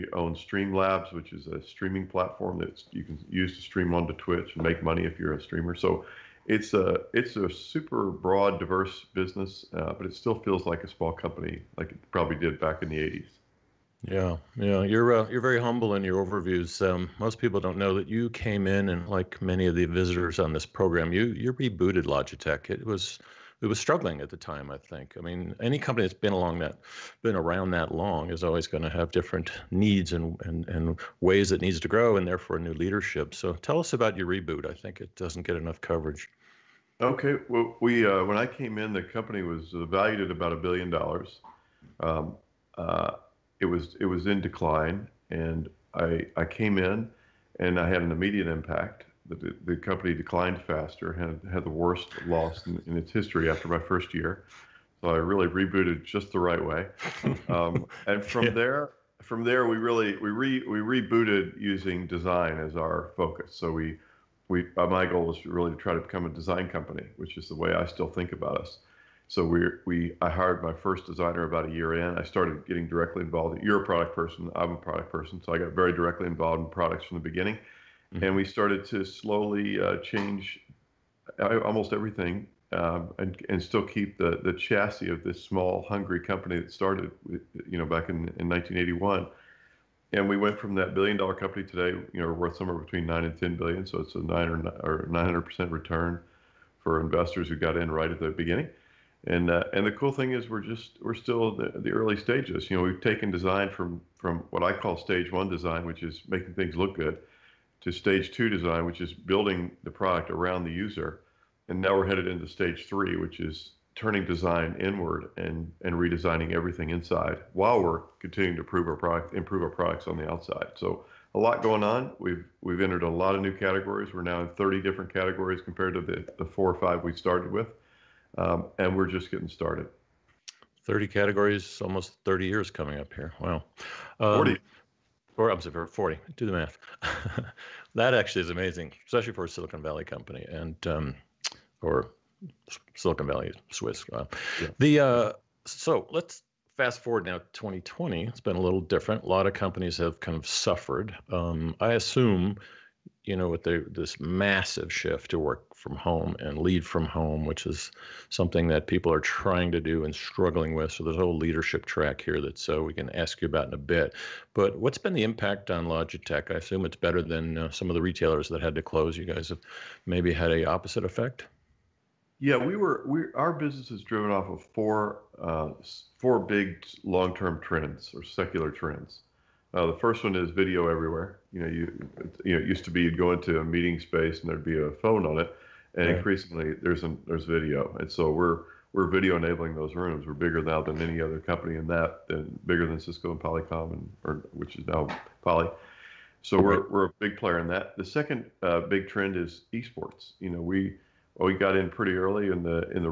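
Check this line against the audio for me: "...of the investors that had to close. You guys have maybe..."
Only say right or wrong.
wrong.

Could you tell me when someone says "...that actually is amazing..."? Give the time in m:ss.
2:17.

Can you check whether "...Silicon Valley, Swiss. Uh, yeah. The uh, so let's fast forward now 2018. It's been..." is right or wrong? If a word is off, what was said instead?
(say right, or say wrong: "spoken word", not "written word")
wrong: "2020", not "2018".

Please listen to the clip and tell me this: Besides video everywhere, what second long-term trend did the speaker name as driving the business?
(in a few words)
esports.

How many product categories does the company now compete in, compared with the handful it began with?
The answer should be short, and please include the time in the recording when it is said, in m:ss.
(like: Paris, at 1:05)
30, at 2:04.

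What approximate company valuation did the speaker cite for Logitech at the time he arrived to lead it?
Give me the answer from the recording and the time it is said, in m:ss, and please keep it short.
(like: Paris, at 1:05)
1 billion dollars, at 0:40.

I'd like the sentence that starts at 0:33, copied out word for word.
So, tell us about your reboot.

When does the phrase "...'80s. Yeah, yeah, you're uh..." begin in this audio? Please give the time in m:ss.
0:12.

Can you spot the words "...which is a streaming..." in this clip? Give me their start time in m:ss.
0:01.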